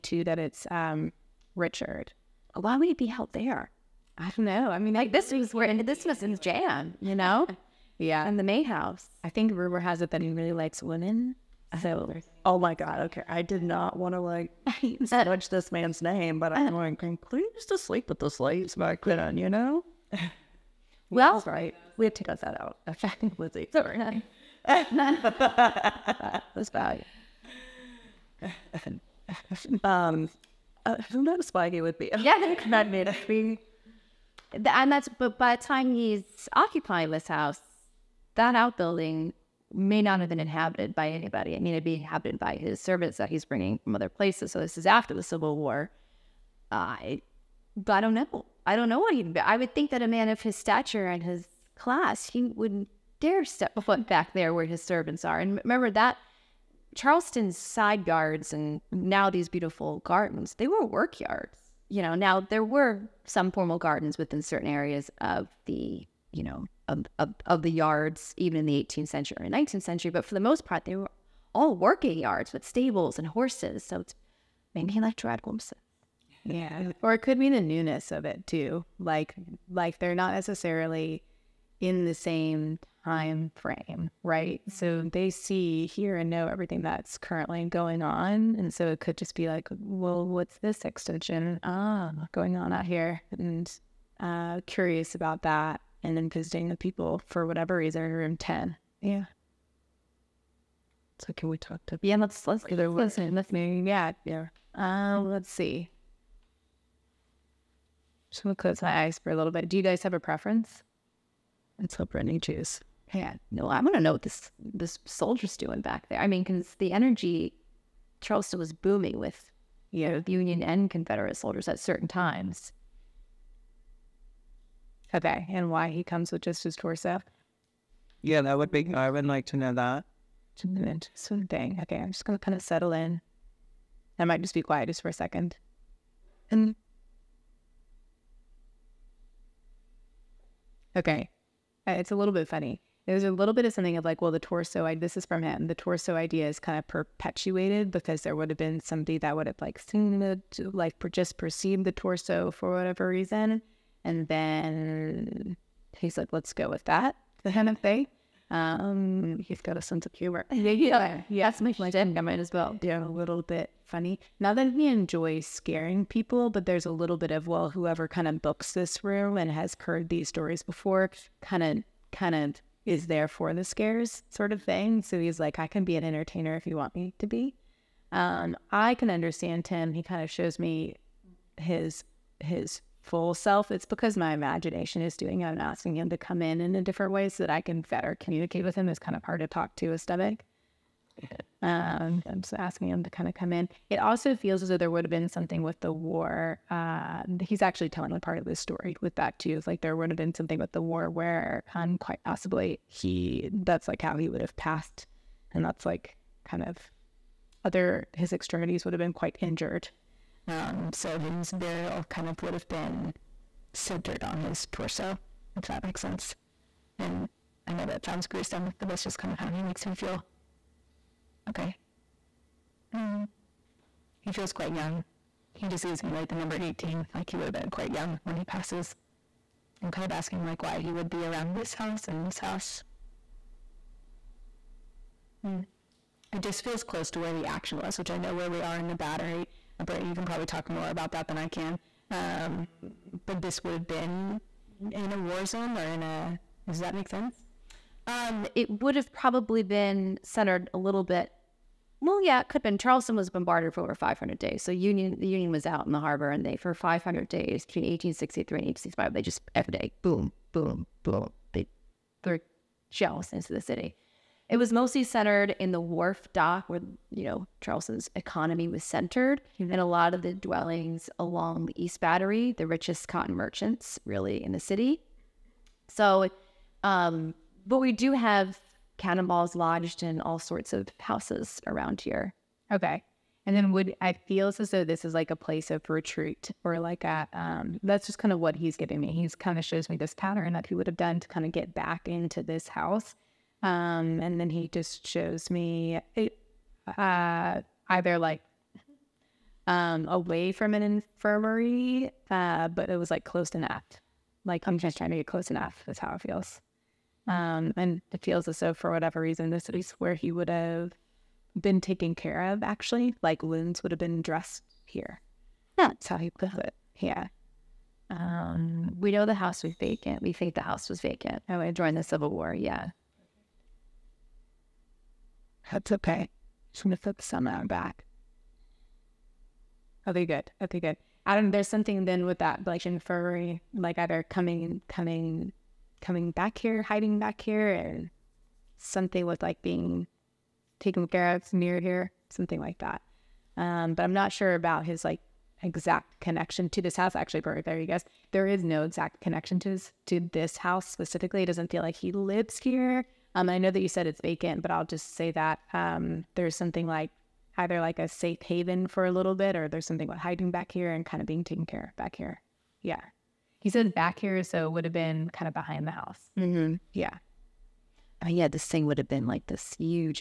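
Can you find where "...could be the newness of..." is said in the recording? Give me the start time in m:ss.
1:17.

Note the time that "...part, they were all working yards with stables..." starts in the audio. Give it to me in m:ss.
1:10.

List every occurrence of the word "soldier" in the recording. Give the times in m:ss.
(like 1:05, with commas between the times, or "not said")
1:55, 2:01.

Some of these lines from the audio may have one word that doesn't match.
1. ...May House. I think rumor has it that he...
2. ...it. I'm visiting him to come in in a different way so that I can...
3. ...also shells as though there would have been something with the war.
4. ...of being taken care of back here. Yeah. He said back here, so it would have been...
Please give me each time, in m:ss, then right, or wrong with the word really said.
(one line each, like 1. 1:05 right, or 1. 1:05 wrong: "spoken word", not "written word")
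1. 0:08 right
2. 3:05 wrong: "asking", not "visiting"
3. 3:13 wrong: "feels", not "shells"
4. 6:01 right.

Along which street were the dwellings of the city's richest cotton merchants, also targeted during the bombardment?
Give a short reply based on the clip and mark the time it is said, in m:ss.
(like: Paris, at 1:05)
East Battery, at 4:31.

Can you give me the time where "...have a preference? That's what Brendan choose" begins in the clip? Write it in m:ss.
1:50.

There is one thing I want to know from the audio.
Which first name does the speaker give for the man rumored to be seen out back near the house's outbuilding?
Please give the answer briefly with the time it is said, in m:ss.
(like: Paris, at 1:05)
Richard, at 0:01.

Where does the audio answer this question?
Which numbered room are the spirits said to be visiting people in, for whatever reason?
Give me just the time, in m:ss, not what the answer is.
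1:38.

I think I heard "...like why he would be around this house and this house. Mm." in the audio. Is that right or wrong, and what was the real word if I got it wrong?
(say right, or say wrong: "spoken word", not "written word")
right.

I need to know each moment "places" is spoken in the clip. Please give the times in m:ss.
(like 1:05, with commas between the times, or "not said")
0:44, 4:45.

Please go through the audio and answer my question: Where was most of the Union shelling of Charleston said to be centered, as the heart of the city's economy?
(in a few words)
The wharf dock.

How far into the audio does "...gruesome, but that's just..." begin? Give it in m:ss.
3:38.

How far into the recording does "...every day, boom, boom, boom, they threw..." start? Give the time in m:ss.
4:19.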